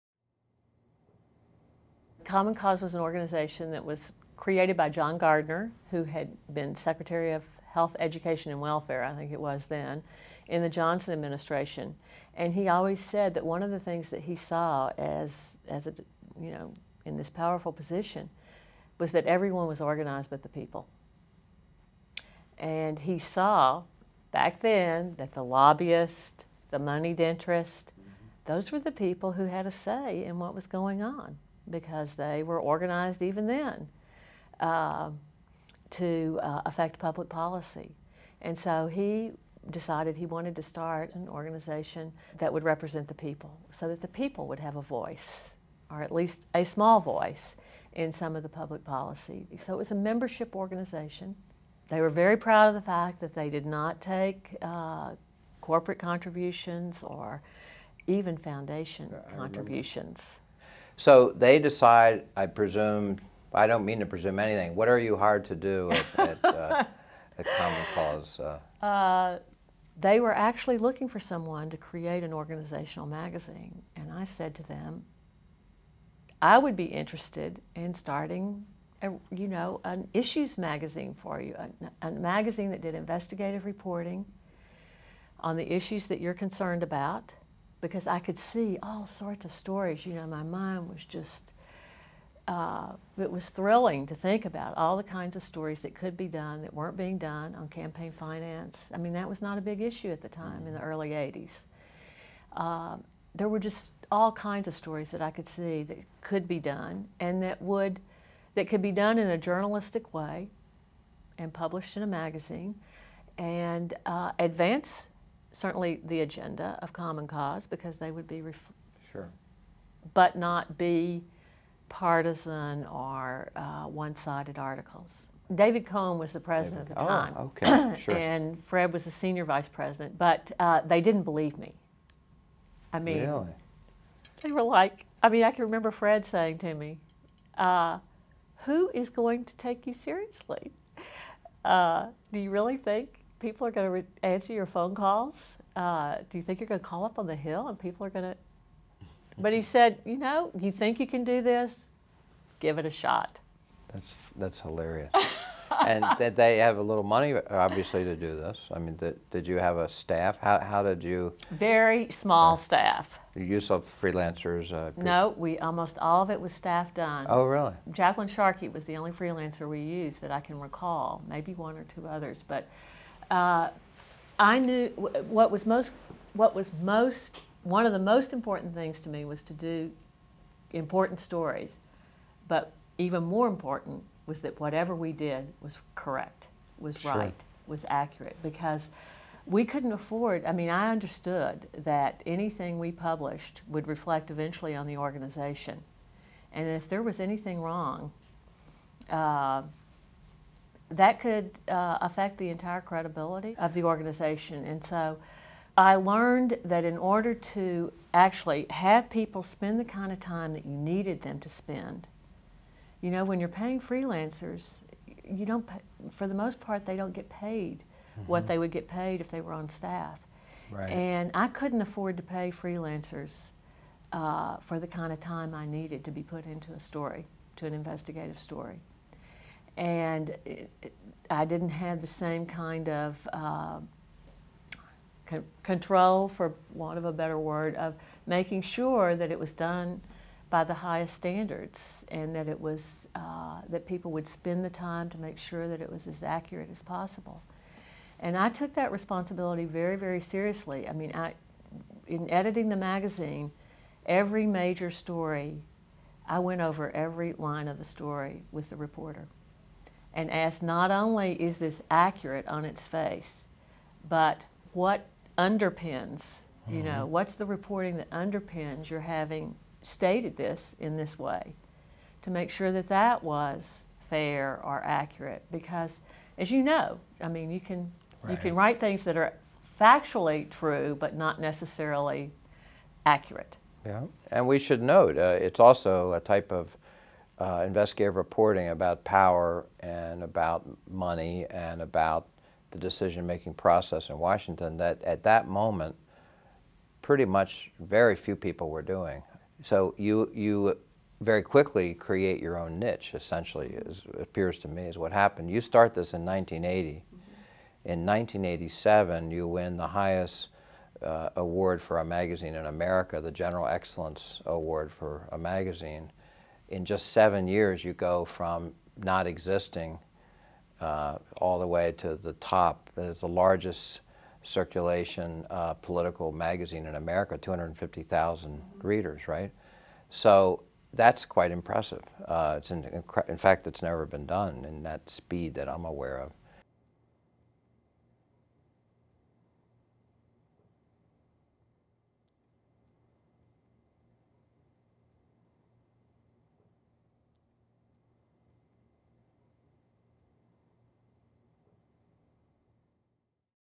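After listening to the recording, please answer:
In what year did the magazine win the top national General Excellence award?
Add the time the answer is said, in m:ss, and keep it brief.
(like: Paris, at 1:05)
1987, at 5:08.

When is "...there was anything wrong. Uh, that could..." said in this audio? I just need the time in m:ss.
3:16.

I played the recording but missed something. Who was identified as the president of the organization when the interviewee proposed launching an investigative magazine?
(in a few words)
David Cohn.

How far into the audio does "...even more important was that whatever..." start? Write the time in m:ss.
3:02.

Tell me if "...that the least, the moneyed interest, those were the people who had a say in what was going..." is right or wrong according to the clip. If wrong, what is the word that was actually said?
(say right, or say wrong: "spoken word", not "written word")
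wrong: "lobbyist", not "least".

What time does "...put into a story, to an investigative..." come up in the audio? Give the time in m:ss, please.
3:46.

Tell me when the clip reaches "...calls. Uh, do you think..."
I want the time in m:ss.
2:24.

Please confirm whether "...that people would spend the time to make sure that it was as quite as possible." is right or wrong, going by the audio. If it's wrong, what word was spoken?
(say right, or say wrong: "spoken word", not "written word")
wrong: "accurate", not "quite".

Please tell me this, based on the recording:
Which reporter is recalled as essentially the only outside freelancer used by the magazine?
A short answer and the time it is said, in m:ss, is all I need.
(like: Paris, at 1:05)
Jacqueline Sharkey, at 2:47.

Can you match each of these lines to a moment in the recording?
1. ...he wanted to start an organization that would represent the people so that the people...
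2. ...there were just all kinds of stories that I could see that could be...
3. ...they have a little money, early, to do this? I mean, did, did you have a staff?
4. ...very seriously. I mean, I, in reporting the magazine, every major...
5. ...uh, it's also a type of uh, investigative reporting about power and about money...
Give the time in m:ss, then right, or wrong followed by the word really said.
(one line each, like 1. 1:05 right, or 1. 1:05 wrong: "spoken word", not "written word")
1. 0:40 right
2. 1:43 right
3. 2:36 wrong: "obviously", not "early"
4. 4:09 wrong: "editing", not "reporting"
5. 4:45 right.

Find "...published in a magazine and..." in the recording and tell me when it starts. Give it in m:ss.
1:51.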